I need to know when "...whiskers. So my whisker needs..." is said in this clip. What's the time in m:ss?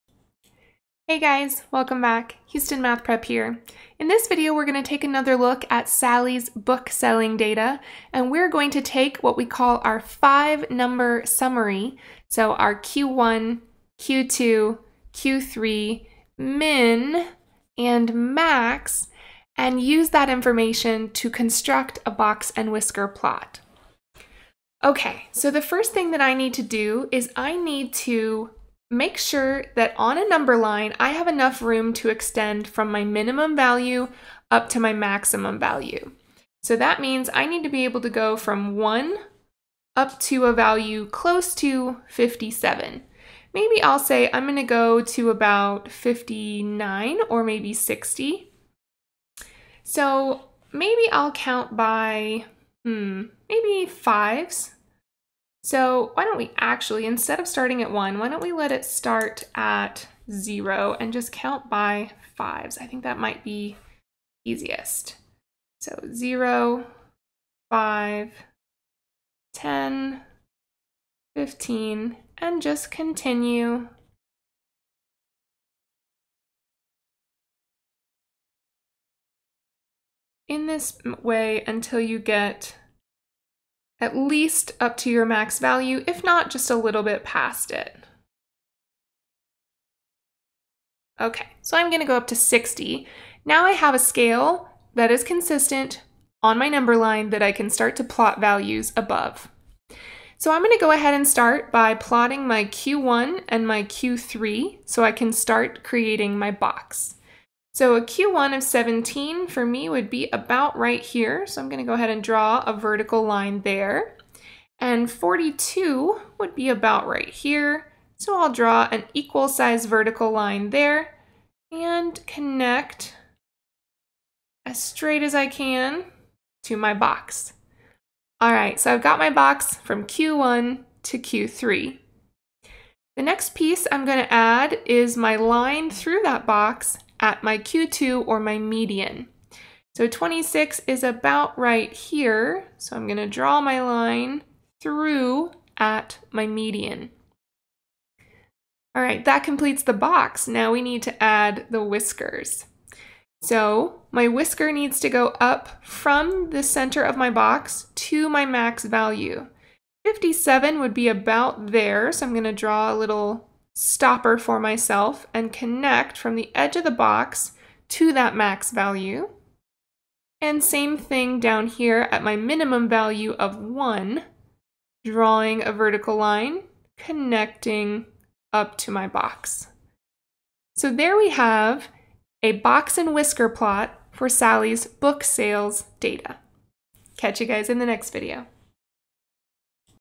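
2:31.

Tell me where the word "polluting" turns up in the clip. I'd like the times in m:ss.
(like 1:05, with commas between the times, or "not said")
not said.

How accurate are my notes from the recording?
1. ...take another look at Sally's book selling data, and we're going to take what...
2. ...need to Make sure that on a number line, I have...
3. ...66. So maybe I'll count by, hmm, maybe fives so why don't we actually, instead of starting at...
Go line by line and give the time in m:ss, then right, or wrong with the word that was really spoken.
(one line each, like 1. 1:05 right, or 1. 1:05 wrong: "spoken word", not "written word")
1. 0:04 right
2. 0:27 right
3. 0:47 wrong: "60", not "66".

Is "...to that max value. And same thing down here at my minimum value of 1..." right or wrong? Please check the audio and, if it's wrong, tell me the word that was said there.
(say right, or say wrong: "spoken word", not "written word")
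right.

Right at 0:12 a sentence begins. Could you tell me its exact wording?
So our Q1, Q2, Q3, min, and max, and use that information to construct a box and whisker plot.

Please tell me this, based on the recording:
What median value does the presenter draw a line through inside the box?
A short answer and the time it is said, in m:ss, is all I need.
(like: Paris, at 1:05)
26, at 2:20.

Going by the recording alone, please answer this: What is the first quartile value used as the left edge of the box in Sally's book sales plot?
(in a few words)
17.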